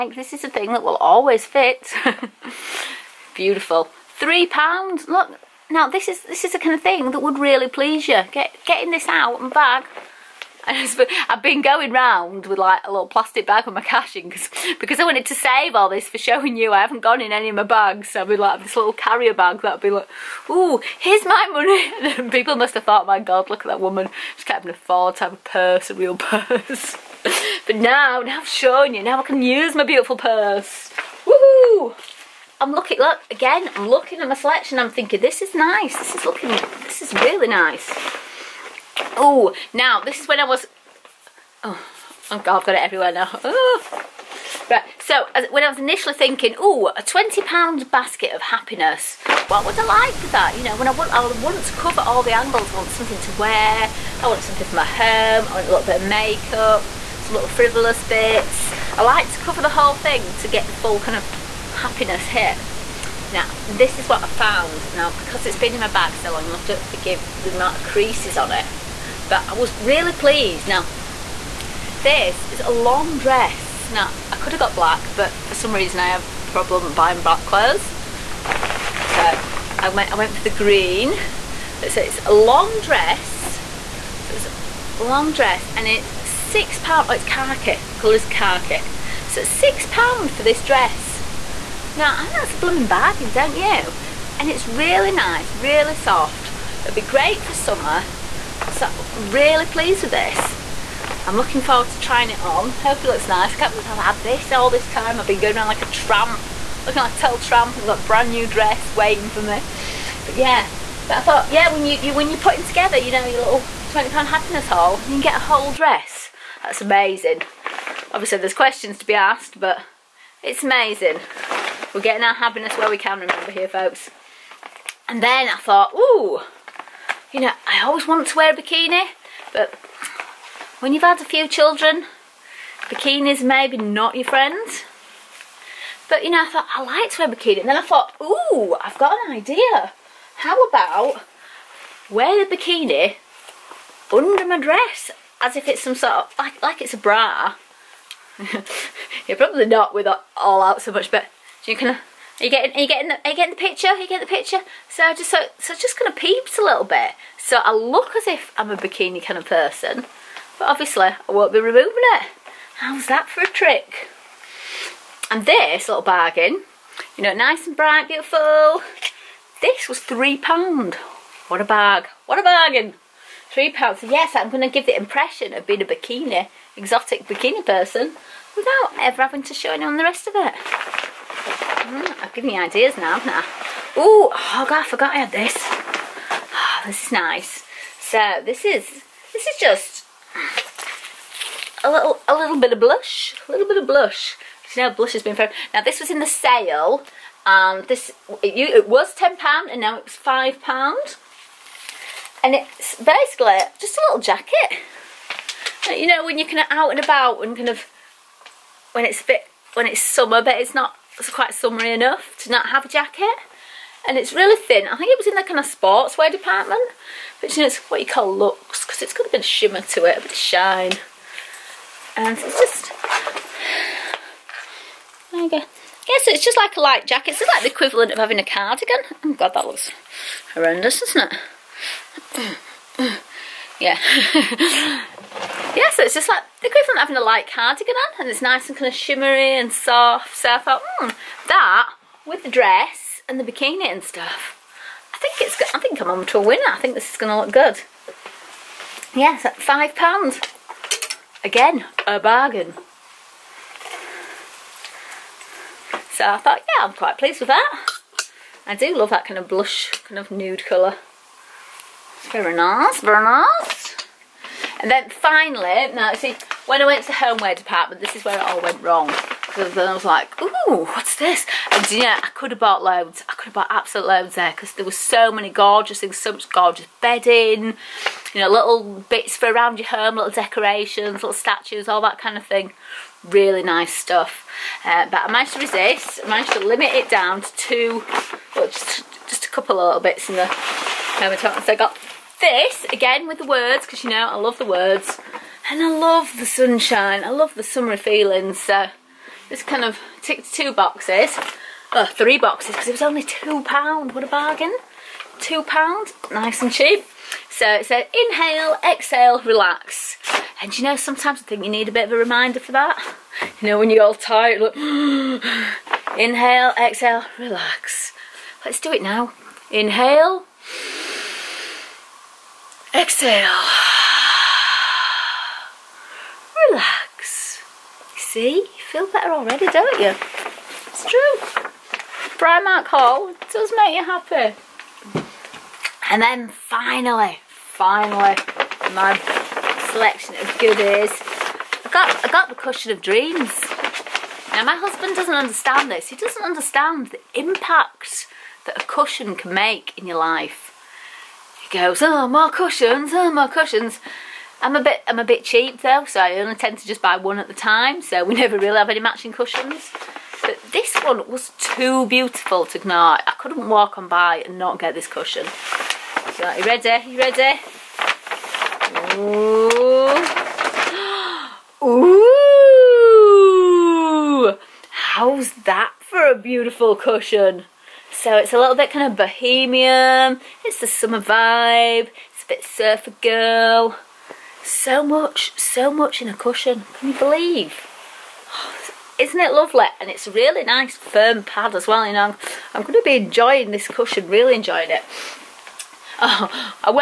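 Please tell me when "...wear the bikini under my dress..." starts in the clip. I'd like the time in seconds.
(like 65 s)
142 s.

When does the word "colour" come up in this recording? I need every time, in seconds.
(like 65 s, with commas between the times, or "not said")
87 s, 260 s.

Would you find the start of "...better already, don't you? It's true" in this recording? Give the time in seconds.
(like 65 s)
329 s.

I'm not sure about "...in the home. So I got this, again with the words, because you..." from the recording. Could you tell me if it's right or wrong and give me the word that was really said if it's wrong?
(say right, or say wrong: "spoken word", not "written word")
right.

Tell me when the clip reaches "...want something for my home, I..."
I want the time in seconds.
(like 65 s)
54 s.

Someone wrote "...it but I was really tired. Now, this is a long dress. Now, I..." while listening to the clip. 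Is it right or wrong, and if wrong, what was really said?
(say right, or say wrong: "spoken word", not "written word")
wrong: "pleased", not "tired".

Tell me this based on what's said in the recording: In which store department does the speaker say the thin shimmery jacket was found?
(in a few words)
sportswear department.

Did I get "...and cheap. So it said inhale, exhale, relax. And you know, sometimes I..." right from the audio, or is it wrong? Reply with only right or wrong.
right.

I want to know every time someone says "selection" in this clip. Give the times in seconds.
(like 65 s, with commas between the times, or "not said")
34 s, 339 s.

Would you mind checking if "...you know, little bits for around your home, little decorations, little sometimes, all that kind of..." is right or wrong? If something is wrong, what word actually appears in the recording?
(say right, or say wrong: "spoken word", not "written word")
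wrong: "statues", not "sometimes".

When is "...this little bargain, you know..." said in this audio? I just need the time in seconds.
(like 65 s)
165 s.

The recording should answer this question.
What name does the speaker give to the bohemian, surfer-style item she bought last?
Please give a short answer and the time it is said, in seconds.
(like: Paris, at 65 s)
cushion of dreams, at 342 s.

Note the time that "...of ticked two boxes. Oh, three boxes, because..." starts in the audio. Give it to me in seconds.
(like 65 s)
299 s.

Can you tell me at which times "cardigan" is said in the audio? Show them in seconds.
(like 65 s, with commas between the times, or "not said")
228 s, 237 s.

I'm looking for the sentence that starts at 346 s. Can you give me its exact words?
He doesn't understand the impact that a cushion can make in your life goes, oh, more cushions, oh, more cushions.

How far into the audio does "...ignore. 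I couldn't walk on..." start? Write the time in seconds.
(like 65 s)
362 s.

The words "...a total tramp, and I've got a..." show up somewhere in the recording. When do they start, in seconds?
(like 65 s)
107 s.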